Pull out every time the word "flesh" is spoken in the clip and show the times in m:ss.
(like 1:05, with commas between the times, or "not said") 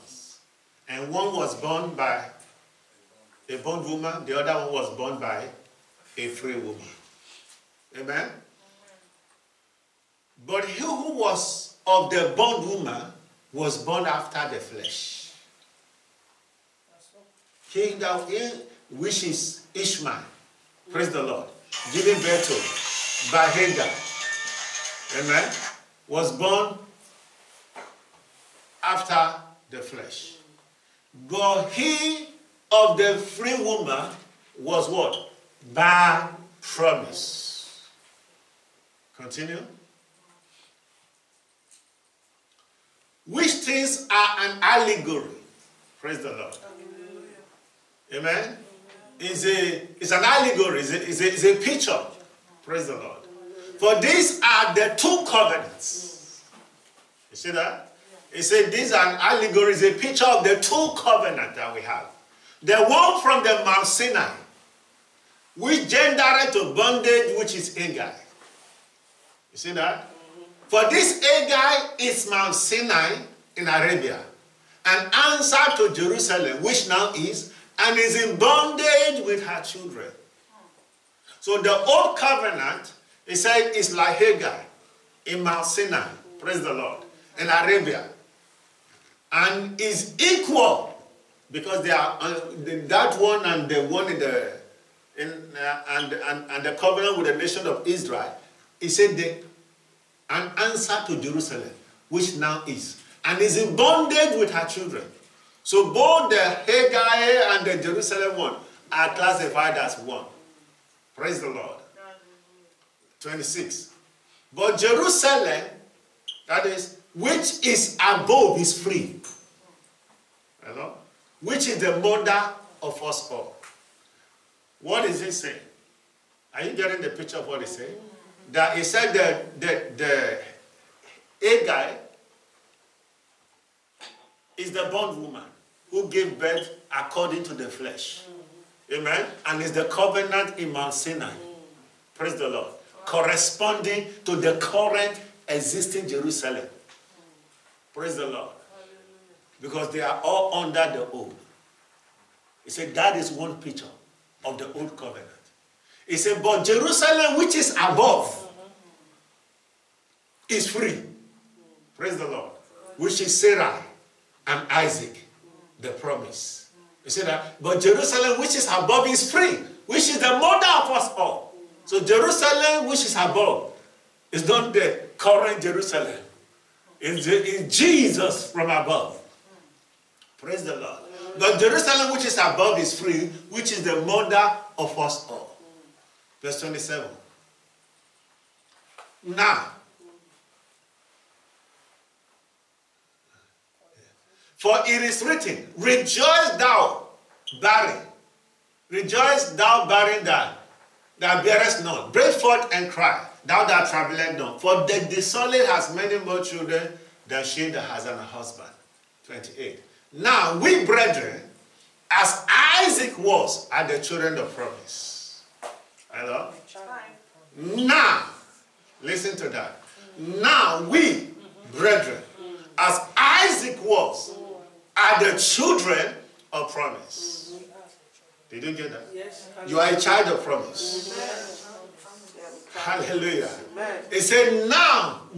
0:14, 0:29, 2:17.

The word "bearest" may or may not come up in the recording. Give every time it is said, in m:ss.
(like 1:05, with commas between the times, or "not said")
3:21.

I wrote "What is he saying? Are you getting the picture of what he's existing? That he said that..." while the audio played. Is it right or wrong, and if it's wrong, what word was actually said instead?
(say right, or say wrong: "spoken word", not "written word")
wrong: "saying", not "existing".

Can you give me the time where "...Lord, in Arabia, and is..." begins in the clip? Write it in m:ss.
1:26.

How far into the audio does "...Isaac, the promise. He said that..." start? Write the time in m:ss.
2:44.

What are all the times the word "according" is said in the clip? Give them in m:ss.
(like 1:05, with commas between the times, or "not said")
2:16.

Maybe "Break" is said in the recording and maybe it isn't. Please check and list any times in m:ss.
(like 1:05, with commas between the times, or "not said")
3:22.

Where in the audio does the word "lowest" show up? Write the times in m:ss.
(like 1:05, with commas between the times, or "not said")
not said.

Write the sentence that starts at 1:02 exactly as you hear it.
The one from the Mount Sinai, which gendered to bondage, which is Agar.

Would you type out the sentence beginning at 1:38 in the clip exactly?
He said the, an answer to Jerusalem, which now is, and is in bondage with her children.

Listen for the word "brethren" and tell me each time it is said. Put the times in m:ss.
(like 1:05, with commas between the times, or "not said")
3:30, 3:41.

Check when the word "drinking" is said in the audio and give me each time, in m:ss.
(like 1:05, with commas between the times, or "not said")
not said.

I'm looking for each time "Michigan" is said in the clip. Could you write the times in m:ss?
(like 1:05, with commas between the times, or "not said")
not said.